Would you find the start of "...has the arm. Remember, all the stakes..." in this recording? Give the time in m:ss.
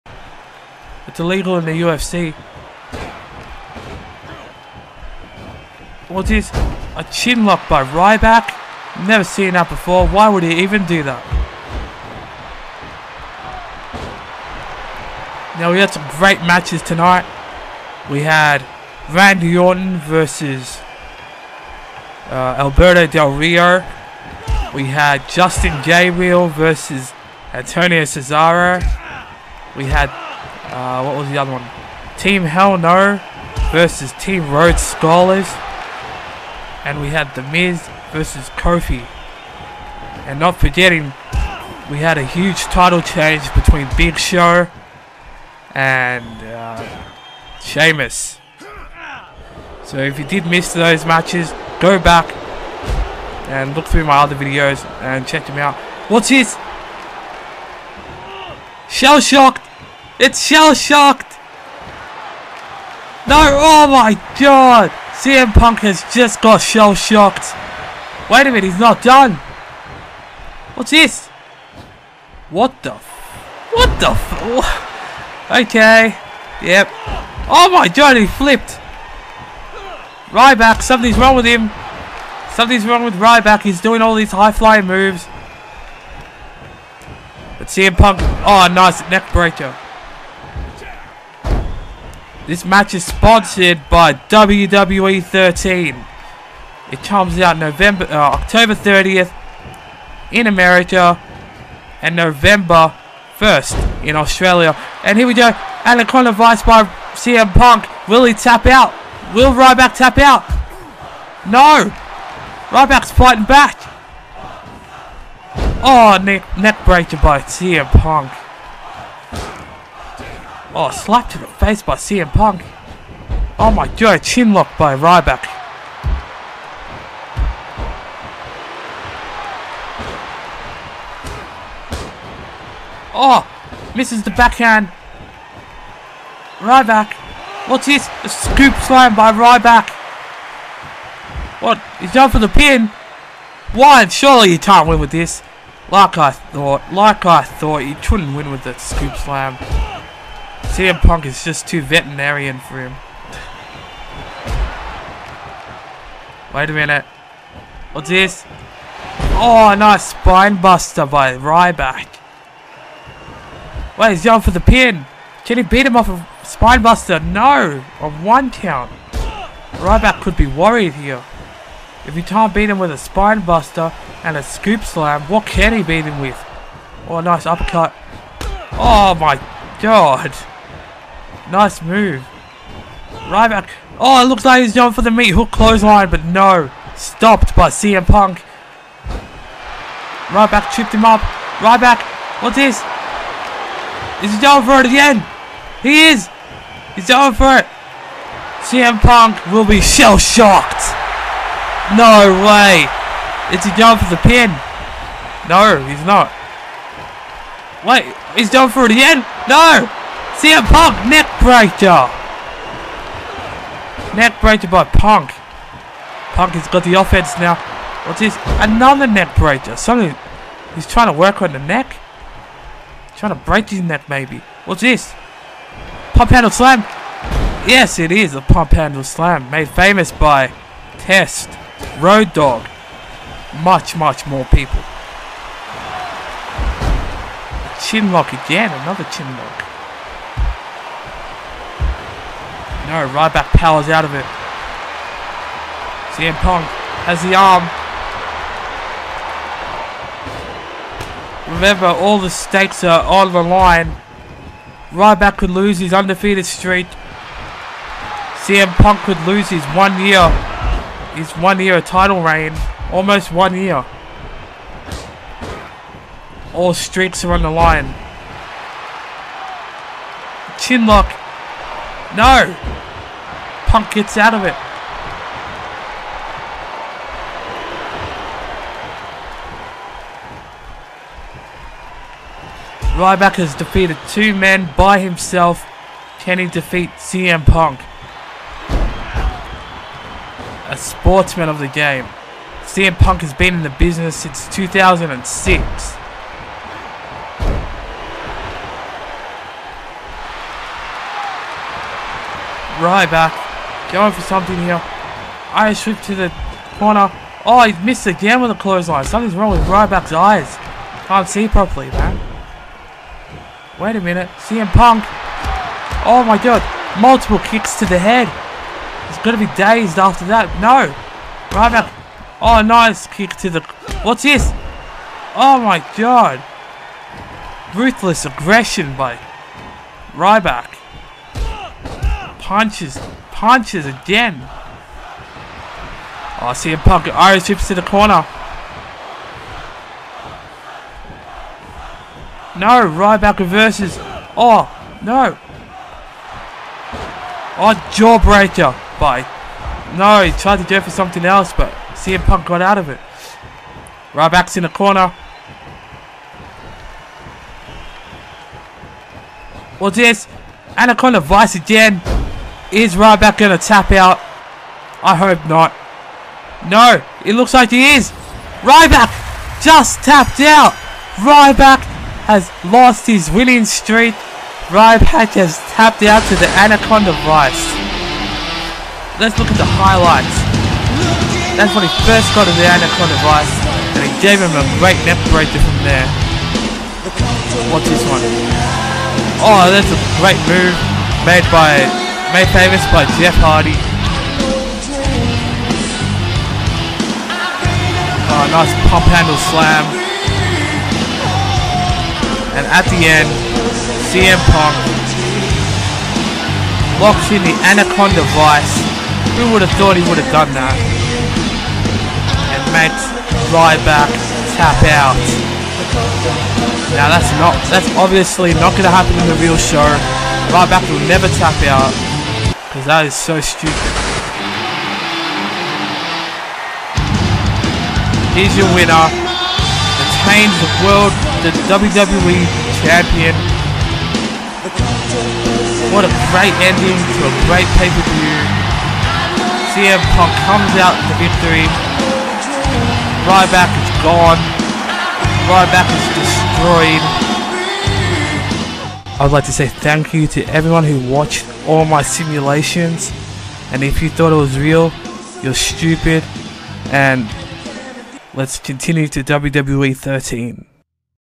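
4:07.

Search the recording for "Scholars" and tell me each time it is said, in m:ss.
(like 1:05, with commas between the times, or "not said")
0:34.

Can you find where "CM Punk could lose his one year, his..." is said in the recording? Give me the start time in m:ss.
4:18.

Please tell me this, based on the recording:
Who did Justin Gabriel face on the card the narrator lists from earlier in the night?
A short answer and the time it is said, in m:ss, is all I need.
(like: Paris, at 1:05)
Antonio Cesaro, at 0:27.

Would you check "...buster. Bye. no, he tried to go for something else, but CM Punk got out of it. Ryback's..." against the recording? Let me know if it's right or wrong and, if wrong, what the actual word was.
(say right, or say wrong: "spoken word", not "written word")
wrong: "jawbreaker", not "buster".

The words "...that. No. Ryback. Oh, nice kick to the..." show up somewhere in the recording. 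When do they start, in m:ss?
5:20.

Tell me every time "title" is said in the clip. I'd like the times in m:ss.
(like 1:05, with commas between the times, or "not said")
0:42, 4:21.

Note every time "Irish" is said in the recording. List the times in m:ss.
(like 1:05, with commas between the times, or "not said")
5:05, 5:37.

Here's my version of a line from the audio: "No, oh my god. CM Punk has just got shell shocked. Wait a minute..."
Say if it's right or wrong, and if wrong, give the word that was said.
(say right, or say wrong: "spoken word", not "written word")
right.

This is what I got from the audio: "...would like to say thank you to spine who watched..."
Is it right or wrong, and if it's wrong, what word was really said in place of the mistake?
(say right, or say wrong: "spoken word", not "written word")
wrong: "everyone", not "spine".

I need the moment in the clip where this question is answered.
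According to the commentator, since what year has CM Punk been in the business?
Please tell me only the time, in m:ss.
4:54.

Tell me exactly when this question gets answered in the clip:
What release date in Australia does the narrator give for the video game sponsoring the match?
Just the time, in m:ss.
1:42.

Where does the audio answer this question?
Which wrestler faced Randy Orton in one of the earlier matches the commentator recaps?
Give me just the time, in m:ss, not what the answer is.
0:22.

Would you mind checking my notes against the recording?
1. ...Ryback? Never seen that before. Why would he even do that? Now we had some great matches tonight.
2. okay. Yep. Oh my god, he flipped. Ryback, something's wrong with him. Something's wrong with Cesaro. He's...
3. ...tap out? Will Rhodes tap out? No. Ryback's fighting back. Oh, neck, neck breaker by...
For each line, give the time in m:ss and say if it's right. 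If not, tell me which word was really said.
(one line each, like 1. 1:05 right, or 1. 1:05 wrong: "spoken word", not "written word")
1. 0:07 right
2. 1:15 wrong: "Ryback", not "Cesaro"
3. 1:48 wrong: "Ryback", not "Rhodes".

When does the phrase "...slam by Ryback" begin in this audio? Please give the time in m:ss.
2:18.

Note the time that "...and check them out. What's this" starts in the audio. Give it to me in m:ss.
0:55.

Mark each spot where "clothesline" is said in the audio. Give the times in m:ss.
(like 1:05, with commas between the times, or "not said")
3:05, 5:08.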